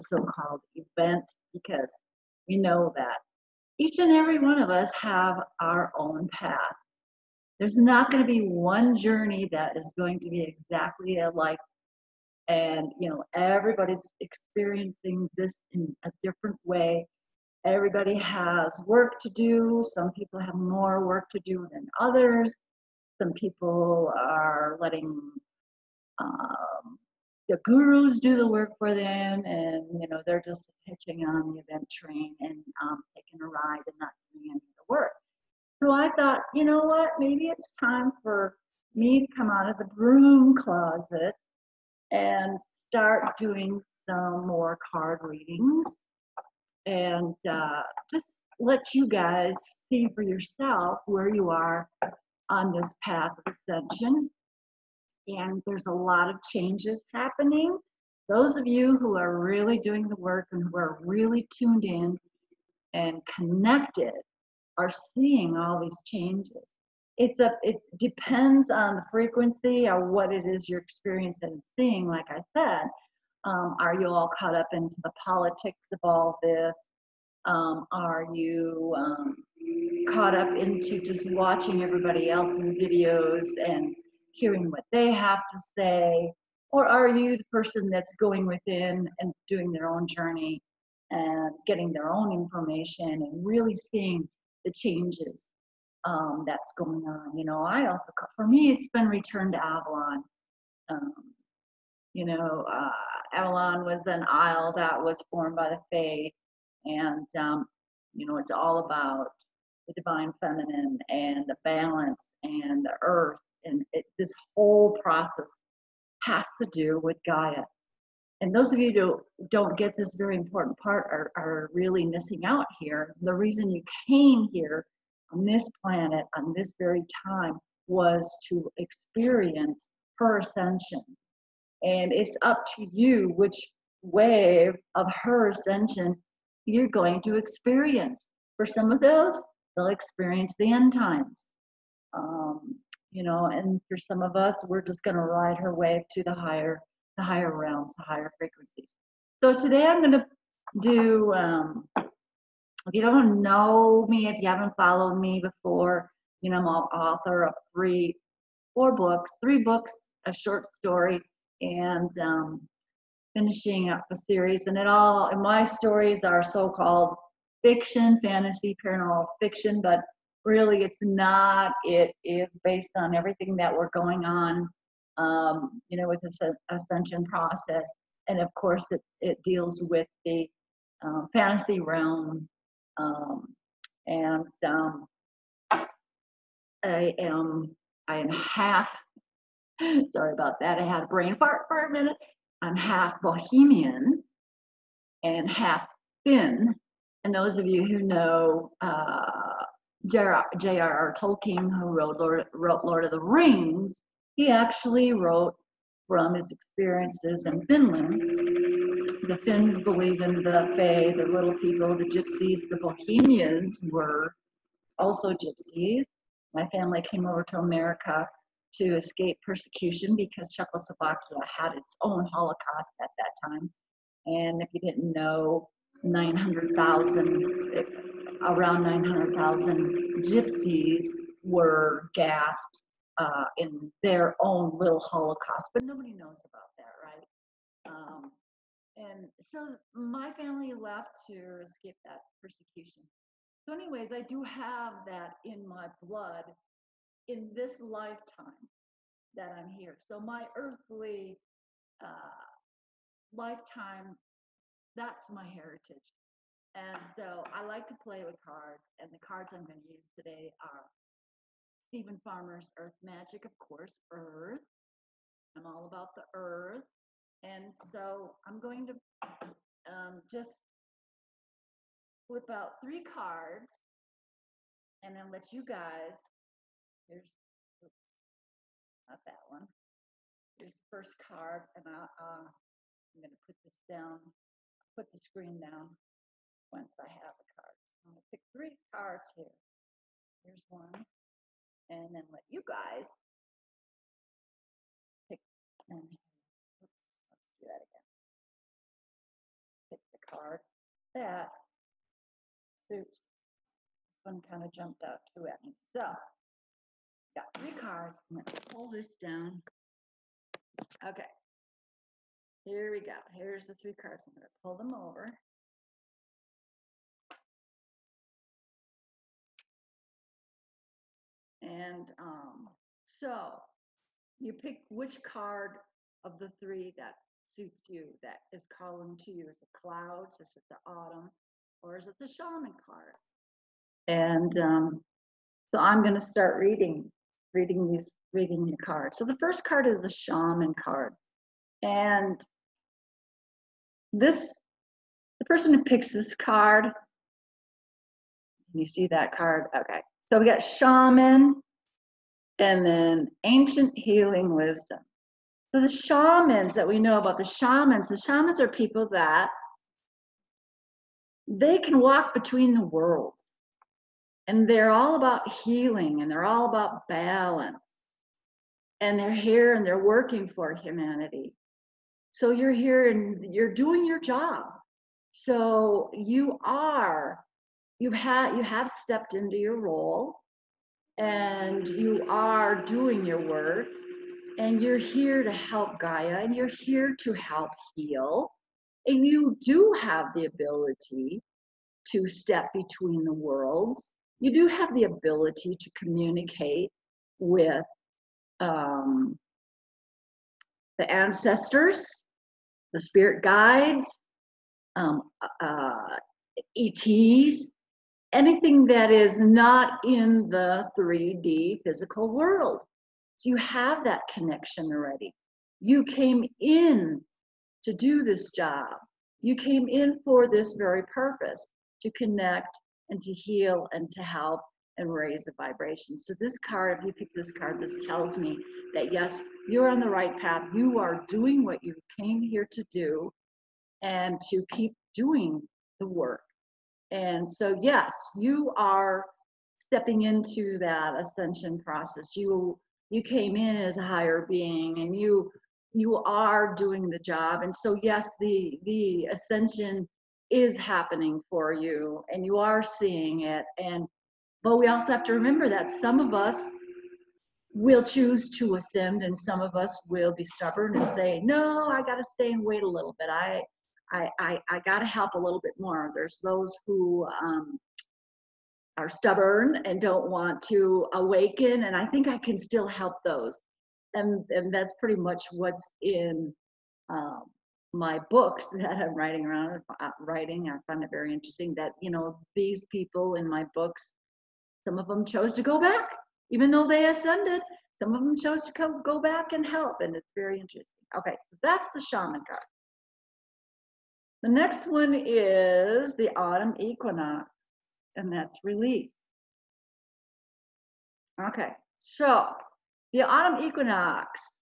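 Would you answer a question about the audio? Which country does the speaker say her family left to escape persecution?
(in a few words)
Czechoslovakia.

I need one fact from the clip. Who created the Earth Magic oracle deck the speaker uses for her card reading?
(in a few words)
Steven Farmer.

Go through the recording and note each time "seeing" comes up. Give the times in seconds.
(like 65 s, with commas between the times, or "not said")
65 s, 71 s, 93 s, 452 s.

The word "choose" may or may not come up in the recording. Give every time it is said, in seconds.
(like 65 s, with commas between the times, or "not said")
458 s.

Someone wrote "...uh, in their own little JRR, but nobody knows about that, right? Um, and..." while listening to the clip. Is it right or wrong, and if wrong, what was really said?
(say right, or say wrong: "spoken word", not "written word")
wrong: "Holocaust", not "JRR".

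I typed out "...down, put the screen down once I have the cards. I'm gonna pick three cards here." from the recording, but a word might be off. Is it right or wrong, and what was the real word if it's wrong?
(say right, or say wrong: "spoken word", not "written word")
right.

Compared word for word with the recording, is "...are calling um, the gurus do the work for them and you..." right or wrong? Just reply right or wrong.
wrong.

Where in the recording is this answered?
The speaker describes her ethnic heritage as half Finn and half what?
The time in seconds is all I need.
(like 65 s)
193 s.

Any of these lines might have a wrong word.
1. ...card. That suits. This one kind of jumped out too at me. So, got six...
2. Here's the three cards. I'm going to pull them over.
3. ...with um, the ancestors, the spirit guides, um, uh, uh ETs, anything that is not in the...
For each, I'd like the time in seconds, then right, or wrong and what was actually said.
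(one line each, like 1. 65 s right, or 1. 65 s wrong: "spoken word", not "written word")
1. 300 s wrong: "three", not "six"
2. 313 s right
3. 397 s right.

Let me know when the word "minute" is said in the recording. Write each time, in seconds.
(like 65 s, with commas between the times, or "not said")
191 s.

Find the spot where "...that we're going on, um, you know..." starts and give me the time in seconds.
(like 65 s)
173 s.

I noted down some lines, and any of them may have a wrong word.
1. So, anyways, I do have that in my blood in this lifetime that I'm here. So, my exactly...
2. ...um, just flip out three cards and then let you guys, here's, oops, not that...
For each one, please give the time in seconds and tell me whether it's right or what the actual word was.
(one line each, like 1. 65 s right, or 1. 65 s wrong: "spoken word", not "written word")
1. 243 s wrong: "earthly", not "exactly"
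2. 269 s right.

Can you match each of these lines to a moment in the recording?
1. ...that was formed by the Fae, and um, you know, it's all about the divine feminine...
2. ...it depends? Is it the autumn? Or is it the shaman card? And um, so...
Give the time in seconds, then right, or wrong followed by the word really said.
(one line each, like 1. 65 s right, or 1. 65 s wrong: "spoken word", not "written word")
1. 104 s right
2. 329 s wrong: "clouds", not "depends".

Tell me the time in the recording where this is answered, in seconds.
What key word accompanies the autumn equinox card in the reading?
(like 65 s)
498 s.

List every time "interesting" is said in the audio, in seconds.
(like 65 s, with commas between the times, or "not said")
481 s, 490 s.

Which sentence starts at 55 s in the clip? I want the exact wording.
And there's a lot of changes happening.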